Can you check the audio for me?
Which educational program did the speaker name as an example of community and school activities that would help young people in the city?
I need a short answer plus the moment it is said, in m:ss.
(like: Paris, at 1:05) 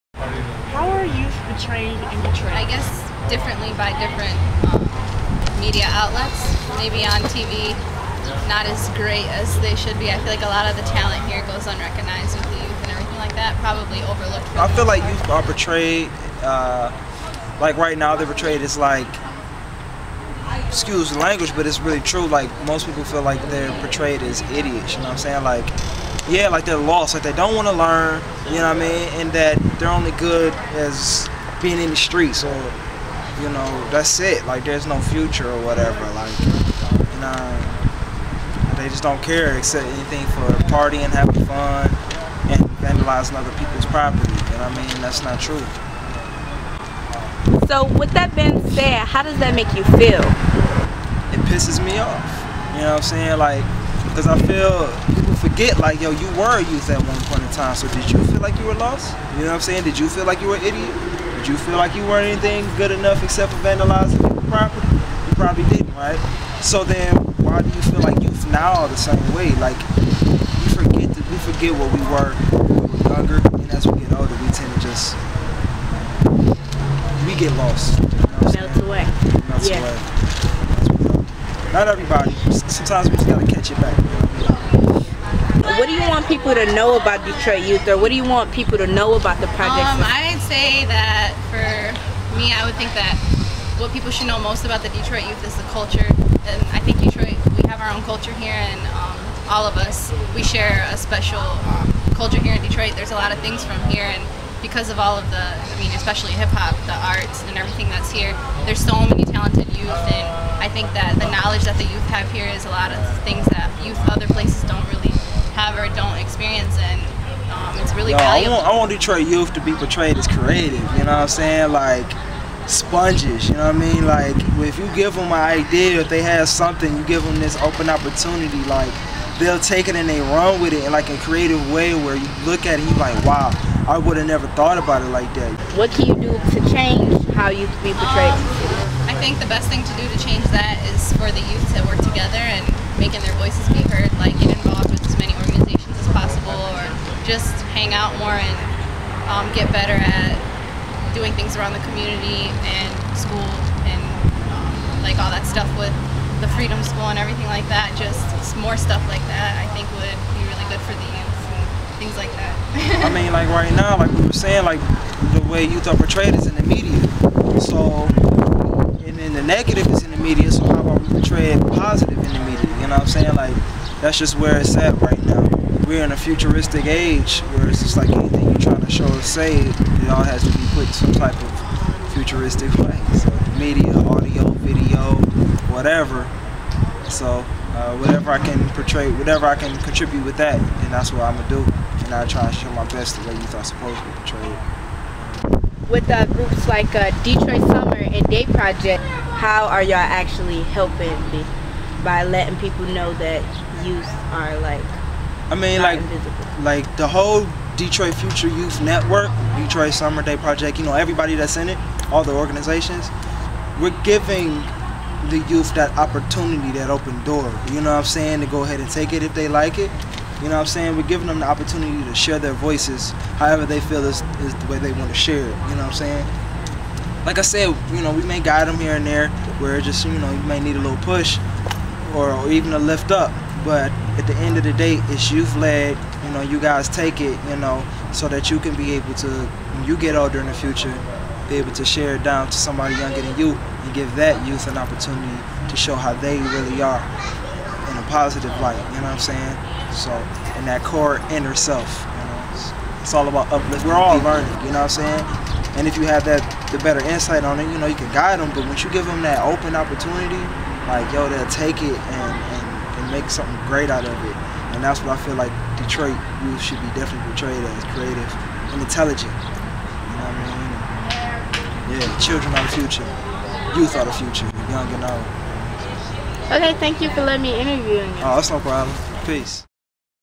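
Freedom School, at 2:36.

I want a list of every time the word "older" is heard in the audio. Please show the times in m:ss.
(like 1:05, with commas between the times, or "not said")
1:14, 4:00.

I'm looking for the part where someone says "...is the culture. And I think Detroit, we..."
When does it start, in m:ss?
1:35.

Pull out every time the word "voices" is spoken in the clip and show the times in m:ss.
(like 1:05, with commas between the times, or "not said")
2:23, 3:42.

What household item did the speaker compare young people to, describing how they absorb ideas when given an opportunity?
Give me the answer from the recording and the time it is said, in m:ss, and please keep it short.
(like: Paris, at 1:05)
sponges, at 2:02.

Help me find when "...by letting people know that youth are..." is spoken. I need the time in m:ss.
3:22.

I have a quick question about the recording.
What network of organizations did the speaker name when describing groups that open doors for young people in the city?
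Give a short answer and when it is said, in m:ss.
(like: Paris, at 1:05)
Detroit Future Youth Network, at 3:27.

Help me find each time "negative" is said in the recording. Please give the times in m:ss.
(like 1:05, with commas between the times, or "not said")
2:49.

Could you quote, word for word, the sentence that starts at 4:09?
So, in that core inner self, you know, it's, it's all about uplift.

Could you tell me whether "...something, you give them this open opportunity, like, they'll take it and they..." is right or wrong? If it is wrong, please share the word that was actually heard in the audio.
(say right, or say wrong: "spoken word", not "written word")
right.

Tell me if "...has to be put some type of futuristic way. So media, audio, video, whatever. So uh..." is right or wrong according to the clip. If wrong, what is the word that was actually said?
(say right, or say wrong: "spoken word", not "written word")
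right.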